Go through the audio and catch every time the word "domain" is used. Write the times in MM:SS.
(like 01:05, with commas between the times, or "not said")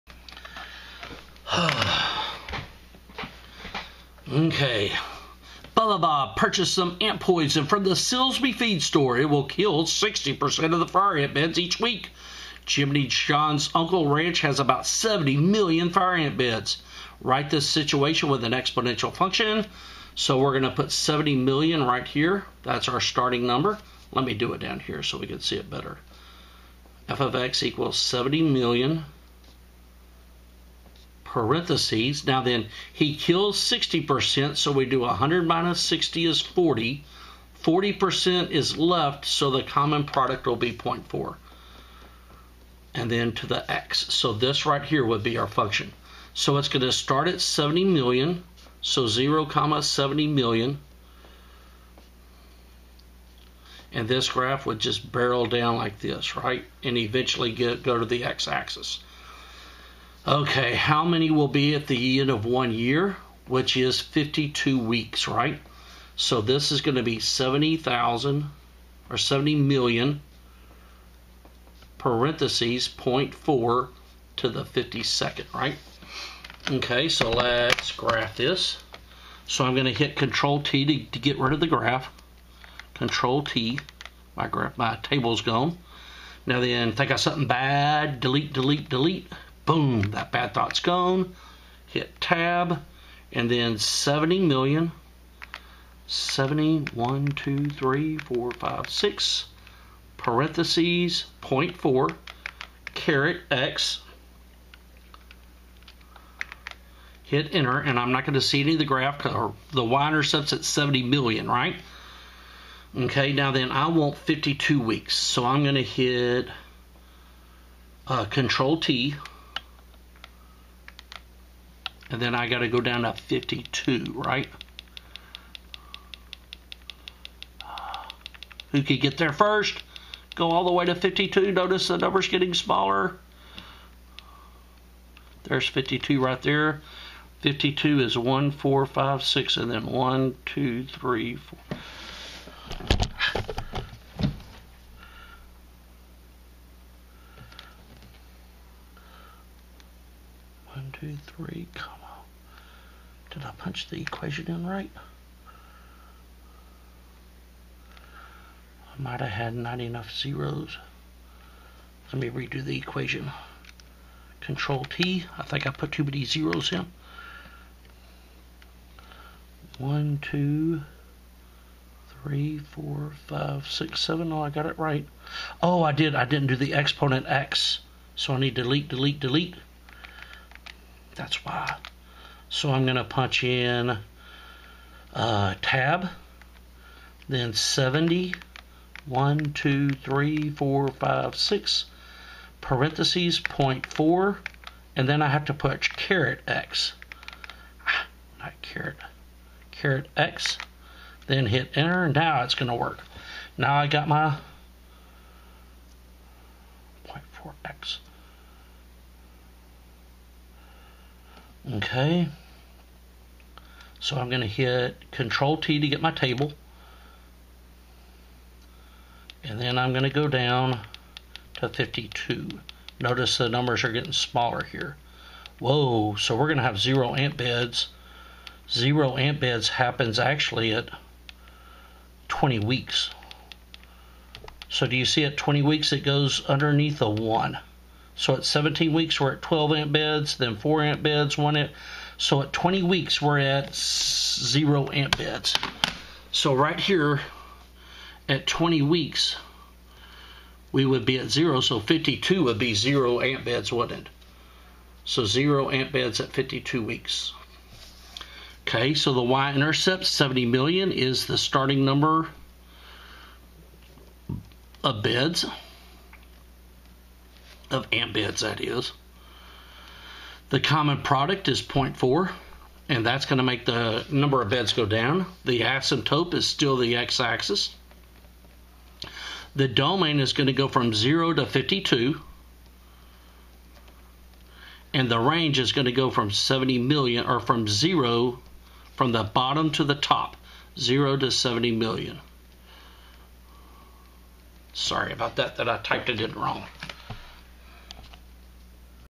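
04:39.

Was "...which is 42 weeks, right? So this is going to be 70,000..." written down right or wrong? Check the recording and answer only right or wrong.
wrong.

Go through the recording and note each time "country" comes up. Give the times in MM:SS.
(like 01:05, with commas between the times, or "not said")
not said.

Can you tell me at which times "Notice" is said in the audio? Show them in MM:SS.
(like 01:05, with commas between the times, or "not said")
02:11, 03:42.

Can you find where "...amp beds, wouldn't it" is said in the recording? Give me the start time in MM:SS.
04:13.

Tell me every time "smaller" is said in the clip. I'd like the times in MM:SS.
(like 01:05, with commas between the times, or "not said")
02:12, 03:44.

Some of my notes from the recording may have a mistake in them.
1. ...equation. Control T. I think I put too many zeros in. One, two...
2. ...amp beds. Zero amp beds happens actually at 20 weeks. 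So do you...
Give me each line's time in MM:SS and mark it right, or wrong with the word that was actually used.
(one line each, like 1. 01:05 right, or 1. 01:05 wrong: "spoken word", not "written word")
1. 02:42 right
2. 03:47 right.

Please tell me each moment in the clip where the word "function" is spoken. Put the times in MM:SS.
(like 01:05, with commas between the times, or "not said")
00:19, 00:45.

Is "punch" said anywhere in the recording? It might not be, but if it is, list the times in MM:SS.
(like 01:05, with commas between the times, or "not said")
02:33, 03:03, 03:15.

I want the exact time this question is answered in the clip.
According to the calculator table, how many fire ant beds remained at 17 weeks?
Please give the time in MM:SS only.
03:59.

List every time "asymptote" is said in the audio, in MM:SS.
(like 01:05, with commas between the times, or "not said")
04:35.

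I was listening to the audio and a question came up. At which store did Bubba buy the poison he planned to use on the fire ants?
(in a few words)
Silsby feed store.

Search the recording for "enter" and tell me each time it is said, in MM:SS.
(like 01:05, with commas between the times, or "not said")
01:47, 03:21.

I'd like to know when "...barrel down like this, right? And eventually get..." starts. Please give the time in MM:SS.
00:55.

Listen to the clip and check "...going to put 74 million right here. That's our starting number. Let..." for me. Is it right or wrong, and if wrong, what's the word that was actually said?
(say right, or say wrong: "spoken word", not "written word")
wrong: "70", not "74".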